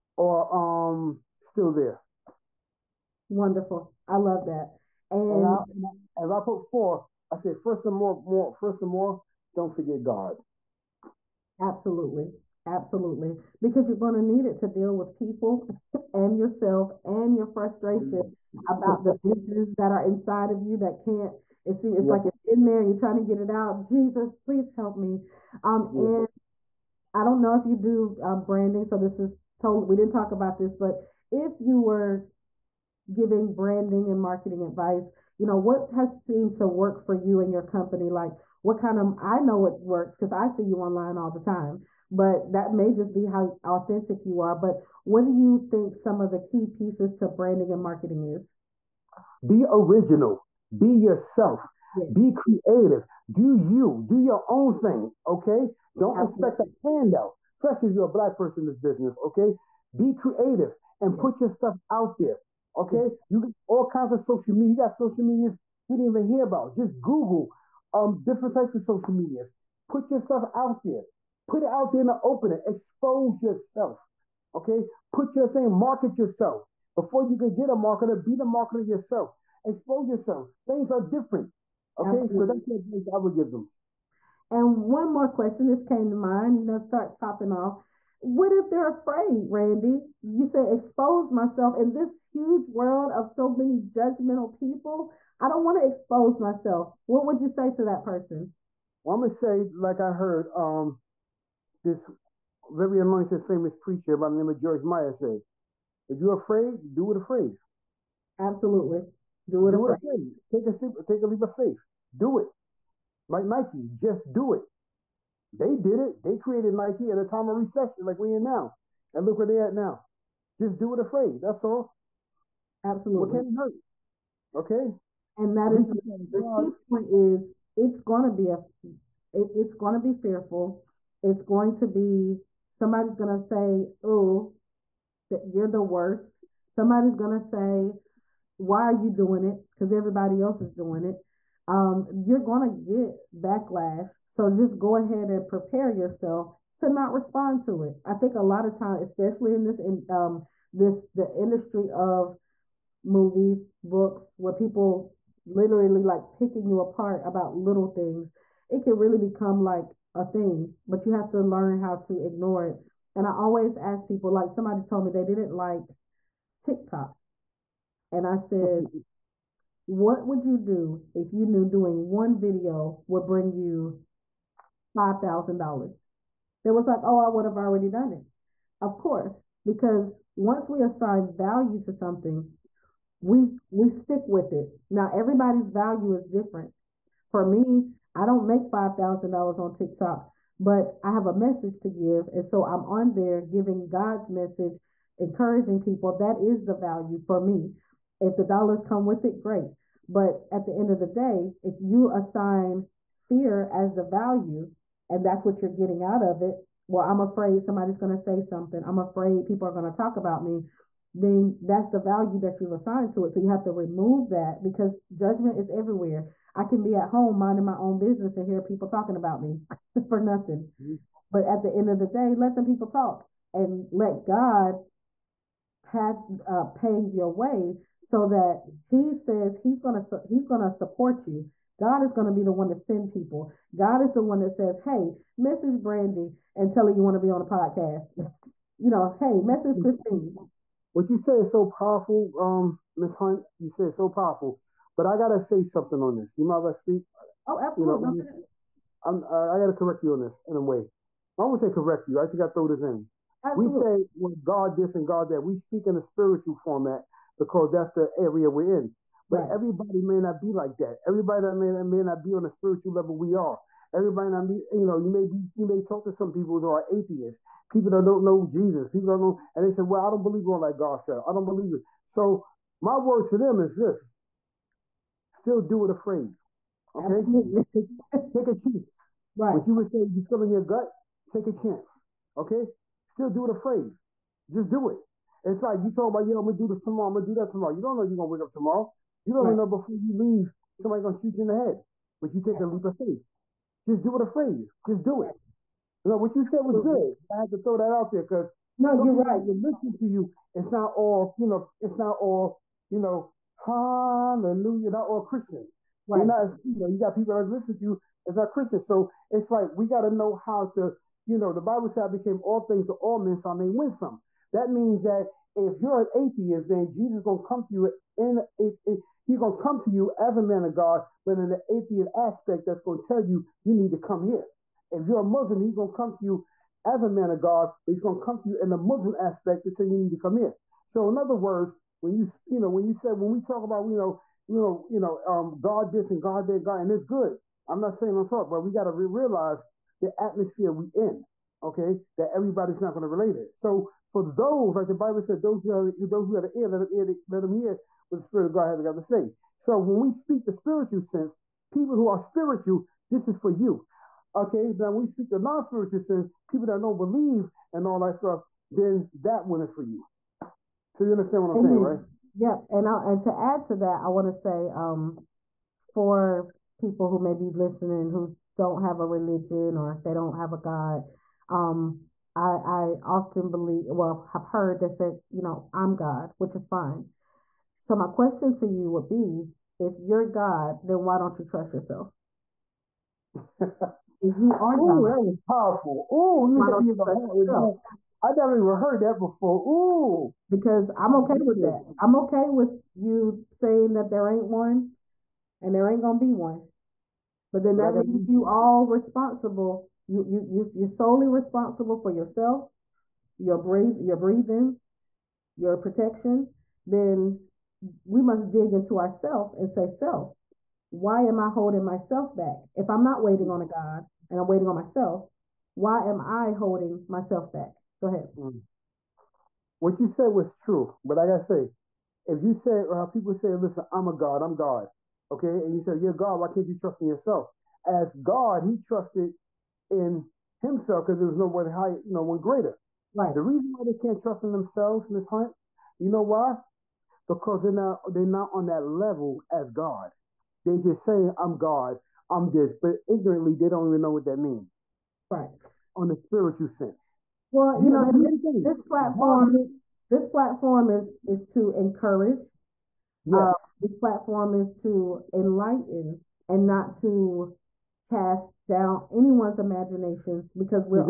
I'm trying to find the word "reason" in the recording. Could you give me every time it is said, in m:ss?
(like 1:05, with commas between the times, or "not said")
7:13.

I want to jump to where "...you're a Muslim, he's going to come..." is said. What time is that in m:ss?
5:25.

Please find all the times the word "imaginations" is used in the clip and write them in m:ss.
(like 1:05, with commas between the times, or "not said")
7:39.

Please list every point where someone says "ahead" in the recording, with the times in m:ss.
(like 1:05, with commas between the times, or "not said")
2:24, 6:58.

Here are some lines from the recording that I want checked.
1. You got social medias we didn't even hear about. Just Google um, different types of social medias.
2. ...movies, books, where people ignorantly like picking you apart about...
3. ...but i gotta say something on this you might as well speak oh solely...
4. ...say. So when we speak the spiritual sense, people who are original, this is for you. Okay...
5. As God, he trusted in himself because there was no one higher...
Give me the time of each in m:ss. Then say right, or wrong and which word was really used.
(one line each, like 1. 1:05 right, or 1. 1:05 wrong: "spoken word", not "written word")
1. 1:04 right
2. 2:33 wrong: "literally", not "ignorantly"
3. 4:04 wrong: "absolutely", not "solely"
4. 5:49 wrong: "spiritual", not "original"
5. 7:07 right.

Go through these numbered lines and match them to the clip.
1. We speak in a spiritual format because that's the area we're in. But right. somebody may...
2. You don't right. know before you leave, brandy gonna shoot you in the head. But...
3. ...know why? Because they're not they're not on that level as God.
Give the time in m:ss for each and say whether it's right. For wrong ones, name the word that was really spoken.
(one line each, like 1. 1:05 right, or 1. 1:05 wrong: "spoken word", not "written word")
1. 4:15 wrong: "everybody", not "somebody"
2. 4:49 wrong: "somebody", not "brandy"
3. 7:16 right.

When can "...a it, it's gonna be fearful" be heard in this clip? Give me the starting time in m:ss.
2:08.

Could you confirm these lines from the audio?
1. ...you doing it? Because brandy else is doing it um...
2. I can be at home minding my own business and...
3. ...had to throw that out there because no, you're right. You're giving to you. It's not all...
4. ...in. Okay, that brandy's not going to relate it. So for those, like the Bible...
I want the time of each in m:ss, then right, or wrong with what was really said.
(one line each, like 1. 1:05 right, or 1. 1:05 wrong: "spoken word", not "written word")
1. 2:18 wrong: "everybody", not "brandy"
2. 3:36 right
3. 4:57 wrong: "listening", not "giving"
4. 5:40 wrong: "everybody", not "brandy".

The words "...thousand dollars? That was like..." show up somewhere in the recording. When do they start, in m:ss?
2:55.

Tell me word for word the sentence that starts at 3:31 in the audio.
Then that's the value that you've assigned to it.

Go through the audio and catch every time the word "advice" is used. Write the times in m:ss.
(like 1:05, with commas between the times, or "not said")
0:34, 1:22.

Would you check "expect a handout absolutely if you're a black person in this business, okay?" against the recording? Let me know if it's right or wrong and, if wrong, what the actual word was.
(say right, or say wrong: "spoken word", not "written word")
wrong: "especially", not "absolutely".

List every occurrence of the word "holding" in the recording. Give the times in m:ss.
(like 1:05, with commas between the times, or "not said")
6:51, 6:56.